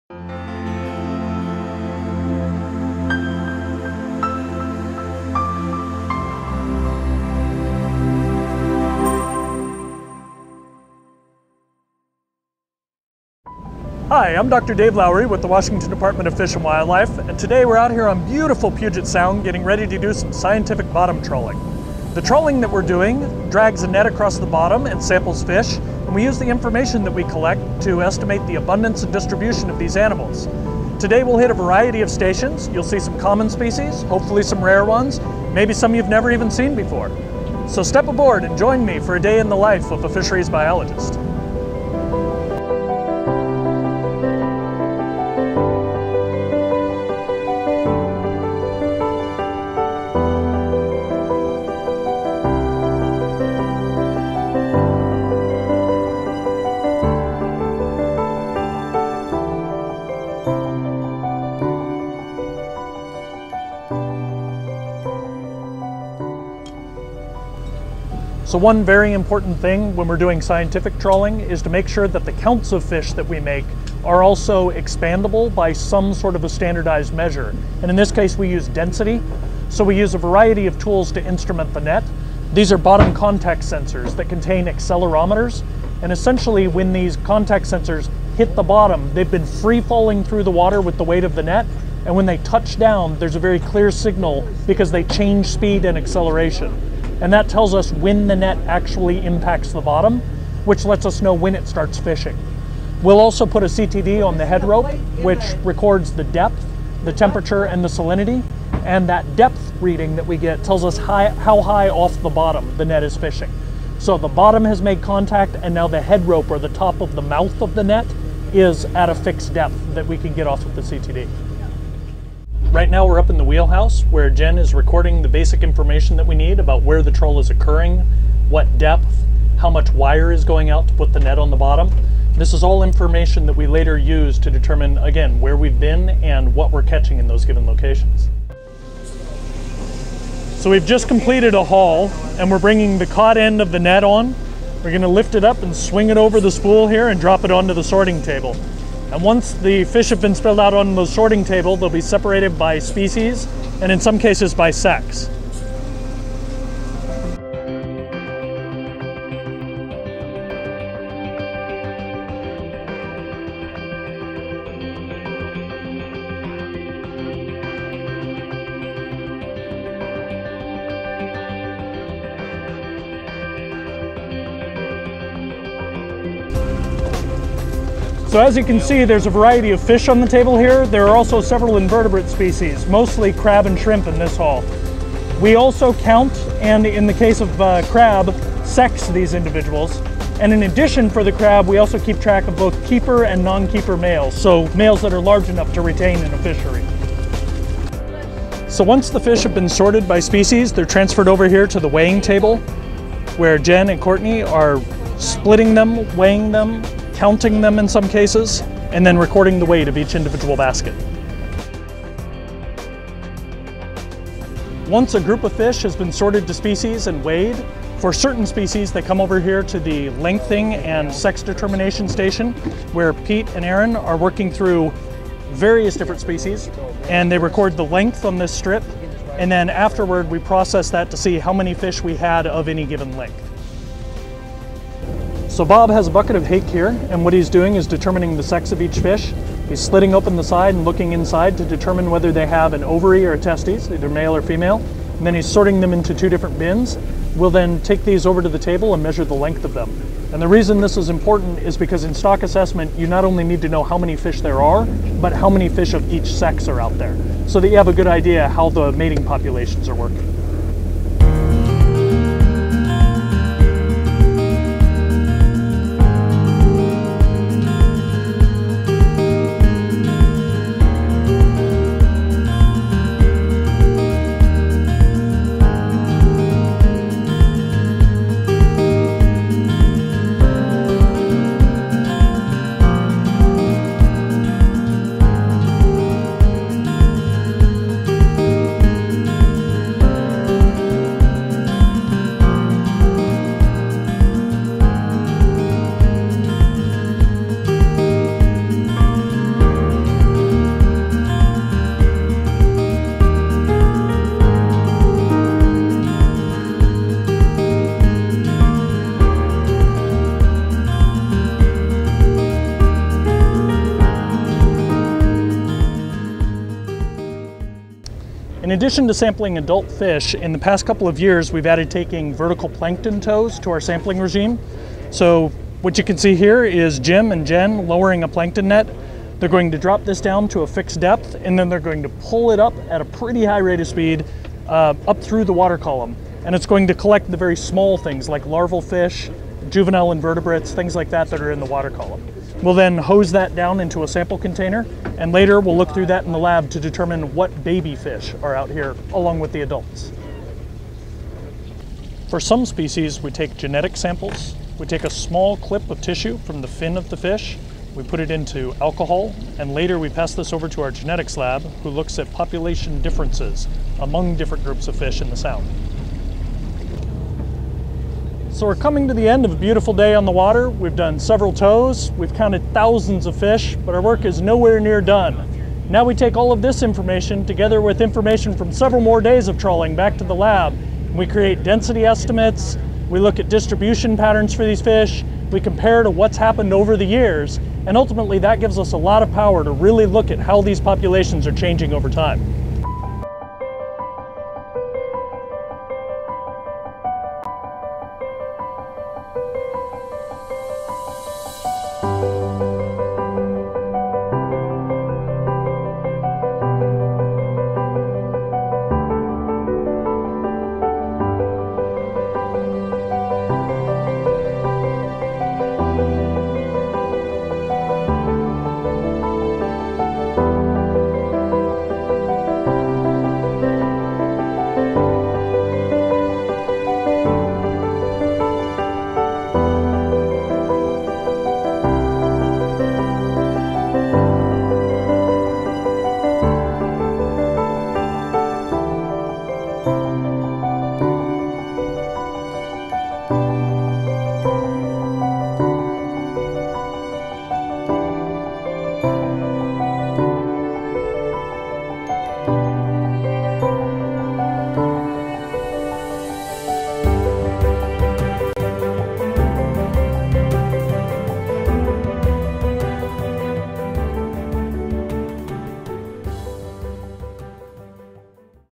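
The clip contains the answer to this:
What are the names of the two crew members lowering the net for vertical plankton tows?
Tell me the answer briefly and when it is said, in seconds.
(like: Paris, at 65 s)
Jim and Jen, at 326 s.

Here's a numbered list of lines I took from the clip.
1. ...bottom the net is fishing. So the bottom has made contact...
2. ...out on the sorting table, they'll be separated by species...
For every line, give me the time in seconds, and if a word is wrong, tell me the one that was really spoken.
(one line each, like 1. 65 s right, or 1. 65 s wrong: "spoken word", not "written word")
1. 112 s right
2. 150 s right.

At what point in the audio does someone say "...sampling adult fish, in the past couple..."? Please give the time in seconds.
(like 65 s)
319 s.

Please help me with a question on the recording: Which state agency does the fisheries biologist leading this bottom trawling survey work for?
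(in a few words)
Washington Department of Fish and Wildlife.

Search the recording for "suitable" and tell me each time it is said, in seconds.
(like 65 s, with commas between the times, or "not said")
not said.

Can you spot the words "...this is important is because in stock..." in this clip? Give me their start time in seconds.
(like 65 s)
250 s.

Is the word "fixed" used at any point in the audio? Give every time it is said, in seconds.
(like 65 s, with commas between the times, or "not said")
119 s, 330 s.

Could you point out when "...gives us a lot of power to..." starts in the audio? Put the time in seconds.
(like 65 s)
388 s.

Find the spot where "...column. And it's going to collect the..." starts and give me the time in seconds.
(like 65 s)
335 s.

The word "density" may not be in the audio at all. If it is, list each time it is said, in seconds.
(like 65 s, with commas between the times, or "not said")
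78 s, 381 s.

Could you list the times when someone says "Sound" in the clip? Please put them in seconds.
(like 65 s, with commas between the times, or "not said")
19 s, 365 s.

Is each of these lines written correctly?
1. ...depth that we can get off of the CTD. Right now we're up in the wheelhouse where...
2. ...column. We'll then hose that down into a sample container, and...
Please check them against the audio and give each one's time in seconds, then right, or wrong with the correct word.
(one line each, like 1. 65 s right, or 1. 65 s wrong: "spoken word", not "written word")
1. 119 s right
2. 341 s right.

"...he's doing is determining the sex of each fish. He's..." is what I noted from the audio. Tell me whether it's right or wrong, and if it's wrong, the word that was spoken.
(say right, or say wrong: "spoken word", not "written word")
right.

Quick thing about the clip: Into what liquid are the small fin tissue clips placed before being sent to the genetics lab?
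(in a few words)
Alcohol.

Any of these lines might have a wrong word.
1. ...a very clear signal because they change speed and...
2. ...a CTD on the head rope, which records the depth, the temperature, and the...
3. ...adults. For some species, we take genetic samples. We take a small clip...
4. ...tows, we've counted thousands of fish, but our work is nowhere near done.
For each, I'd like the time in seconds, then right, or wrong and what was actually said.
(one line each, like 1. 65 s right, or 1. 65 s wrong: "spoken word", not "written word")
1. 93 s right
2. 103 s right
3. 349 s right
4. 371 s right.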